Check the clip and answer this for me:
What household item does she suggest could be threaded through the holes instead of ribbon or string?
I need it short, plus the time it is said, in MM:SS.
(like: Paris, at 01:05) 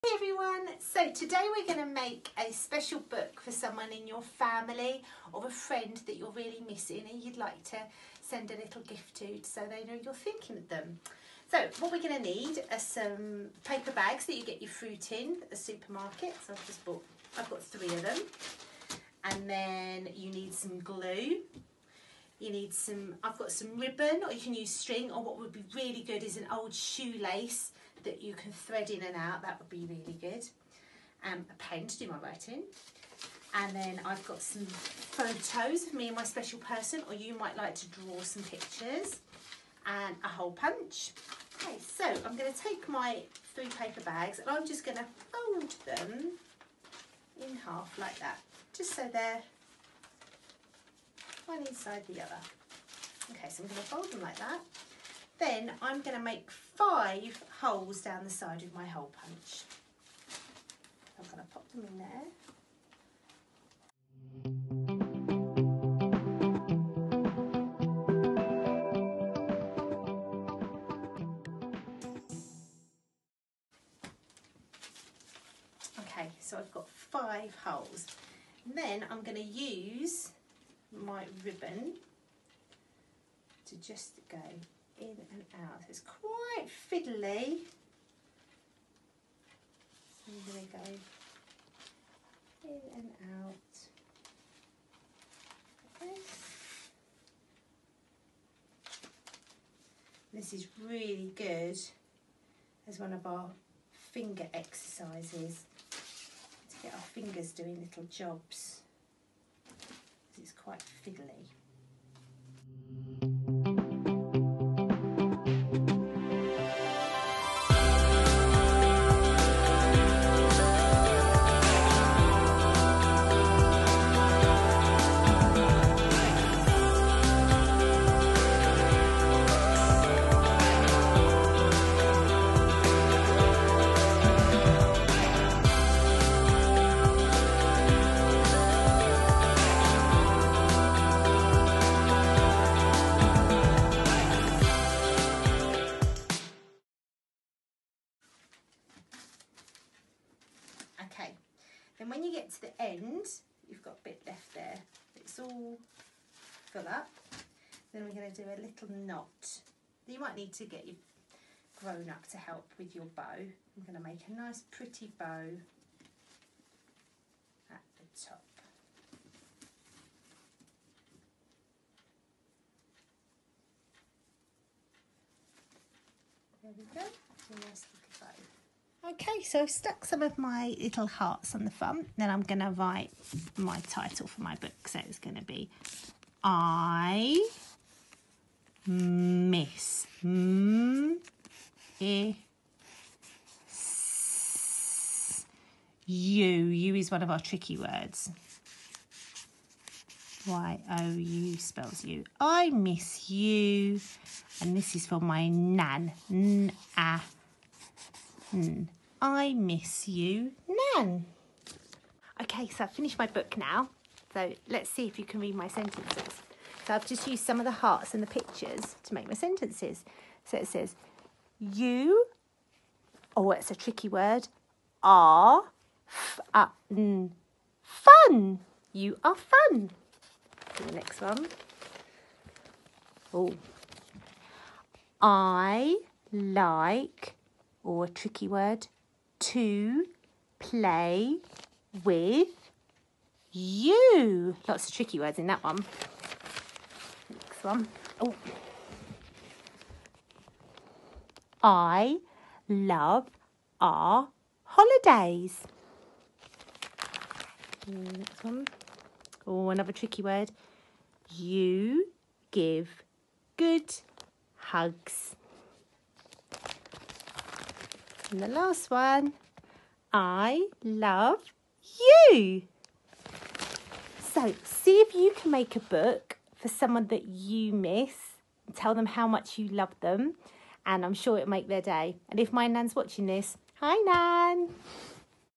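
An old shoelace, at 00:26.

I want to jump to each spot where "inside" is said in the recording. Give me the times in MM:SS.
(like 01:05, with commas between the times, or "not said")
00:51.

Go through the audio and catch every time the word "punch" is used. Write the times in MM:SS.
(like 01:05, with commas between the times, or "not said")
00:40, 00:59.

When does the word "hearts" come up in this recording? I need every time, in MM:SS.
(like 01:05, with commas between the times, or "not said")
03:01, 03:37.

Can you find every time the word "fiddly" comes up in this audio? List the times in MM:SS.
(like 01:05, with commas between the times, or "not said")
01:26, 01:51.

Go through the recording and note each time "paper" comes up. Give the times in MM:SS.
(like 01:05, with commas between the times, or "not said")
00:13, 00:43.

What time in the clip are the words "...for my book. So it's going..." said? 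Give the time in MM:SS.
03:04.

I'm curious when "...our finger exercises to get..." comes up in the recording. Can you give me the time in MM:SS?
01:43.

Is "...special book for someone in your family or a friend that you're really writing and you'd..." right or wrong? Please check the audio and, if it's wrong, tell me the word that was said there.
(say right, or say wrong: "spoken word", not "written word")
wrong: "missing", not "writing".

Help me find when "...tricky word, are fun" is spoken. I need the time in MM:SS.
03:43.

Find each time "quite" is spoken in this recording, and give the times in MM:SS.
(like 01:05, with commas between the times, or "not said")
01:26, 01:50.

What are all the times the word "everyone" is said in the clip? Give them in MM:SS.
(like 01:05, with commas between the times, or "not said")
00:00.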